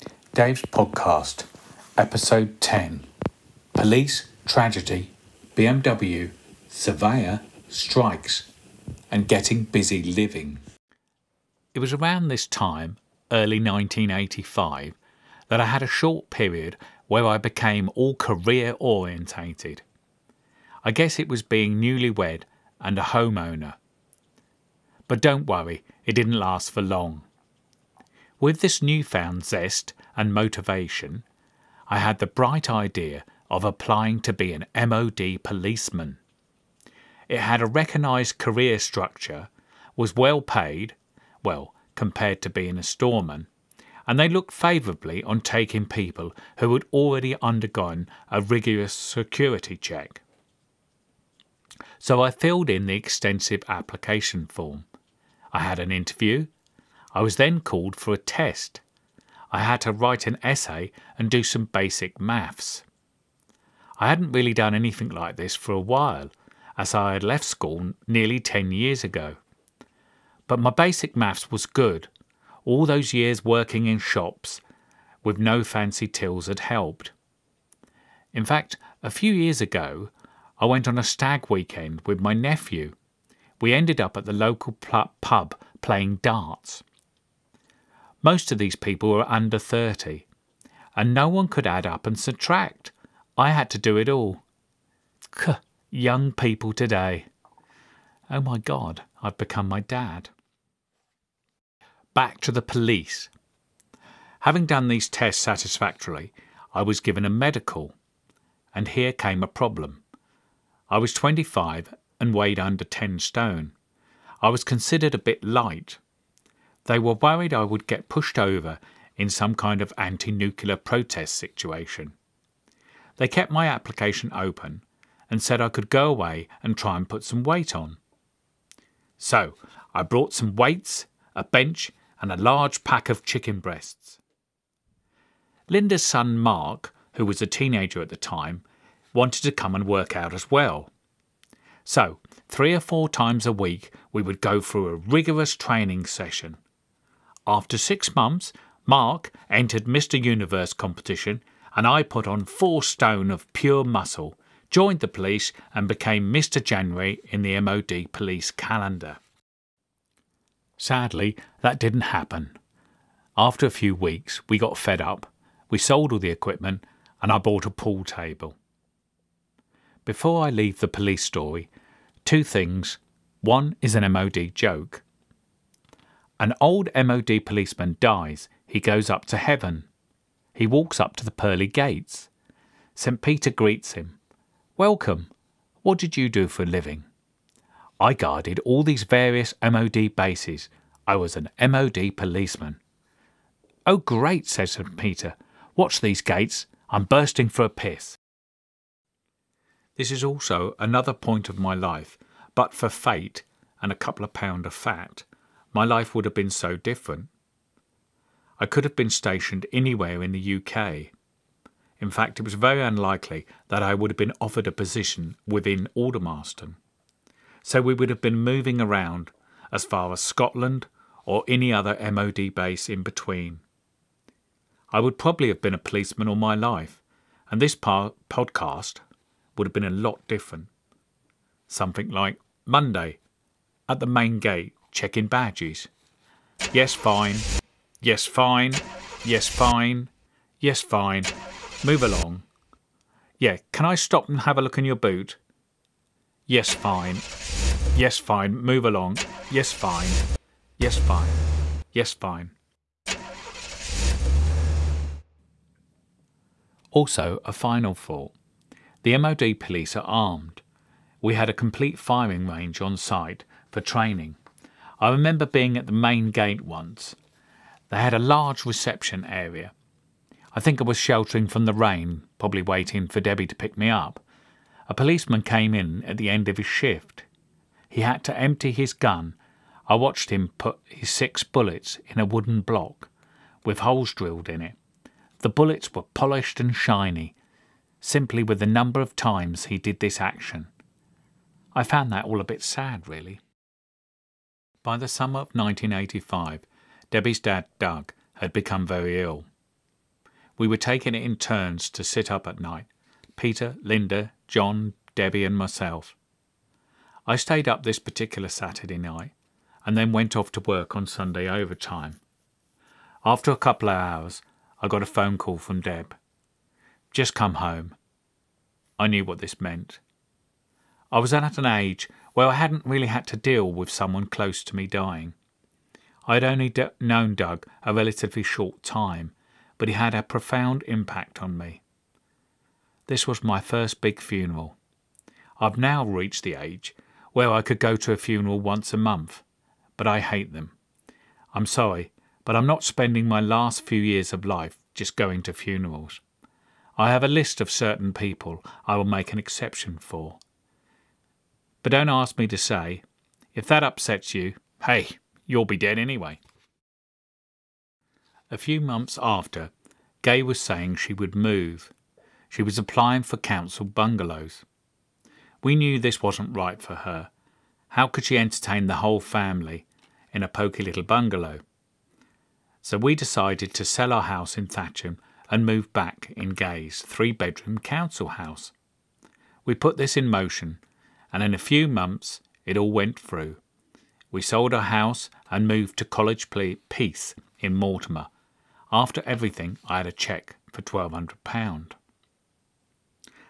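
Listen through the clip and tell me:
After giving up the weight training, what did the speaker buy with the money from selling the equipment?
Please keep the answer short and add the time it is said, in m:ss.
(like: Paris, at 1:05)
A pool table, at 2:47.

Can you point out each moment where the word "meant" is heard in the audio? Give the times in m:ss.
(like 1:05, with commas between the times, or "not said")
5:19.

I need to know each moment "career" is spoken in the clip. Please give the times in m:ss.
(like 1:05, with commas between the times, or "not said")
0:18, 0:38.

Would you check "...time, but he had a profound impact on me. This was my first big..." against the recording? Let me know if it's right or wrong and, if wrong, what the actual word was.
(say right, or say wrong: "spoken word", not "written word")
right.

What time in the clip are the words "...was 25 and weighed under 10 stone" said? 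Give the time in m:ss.
1:50.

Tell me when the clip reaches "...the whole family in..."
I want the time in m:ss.
6:08.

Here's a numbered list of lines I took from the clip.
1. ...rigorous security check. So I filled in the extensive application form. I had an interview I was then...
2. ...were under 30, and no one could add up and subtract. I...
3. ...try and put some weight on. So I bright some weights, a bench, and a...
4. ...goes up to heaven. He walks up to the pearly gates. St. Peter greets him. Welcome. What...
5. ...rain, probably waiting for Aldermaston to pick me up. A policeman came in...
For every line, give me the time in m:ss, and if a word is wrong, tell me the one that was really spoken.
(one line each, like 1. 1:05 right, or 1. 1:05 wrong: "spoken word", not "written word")
1. 0:48 right
2. 1:29 right
3. 2:06 wrong: "brought", not "bright"
4. 2:58 right
5. 4:31 wrong: "Debbie", not "Aldermaston".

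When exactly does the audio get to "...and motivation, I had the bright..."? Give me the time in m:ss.
0:30.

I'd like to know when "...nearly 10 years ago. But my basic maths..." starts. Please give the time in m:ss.
1:08.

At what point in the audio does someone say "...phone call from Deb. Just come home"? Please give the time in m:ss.
5:15.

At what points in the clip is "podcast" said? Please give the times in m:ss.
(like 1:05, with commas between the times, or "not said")
0:00, 3:47.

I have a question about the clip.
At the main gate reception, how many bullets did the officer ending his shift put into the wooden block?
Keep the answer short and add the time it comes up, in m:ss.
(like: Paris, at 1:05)
6, at 4:41.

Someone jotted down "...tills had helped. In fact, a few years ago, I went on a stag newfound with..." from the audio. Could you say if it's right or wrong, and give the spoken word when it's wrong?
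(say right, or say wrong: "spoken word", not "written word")
wrong: "weekend", not "newfound".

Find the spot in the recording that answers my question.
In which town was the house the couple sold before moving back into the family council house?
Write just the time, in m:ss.
6:14.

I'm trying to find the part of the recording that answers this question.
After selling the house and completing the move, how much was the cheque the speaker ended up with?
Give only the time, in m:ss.
6:30.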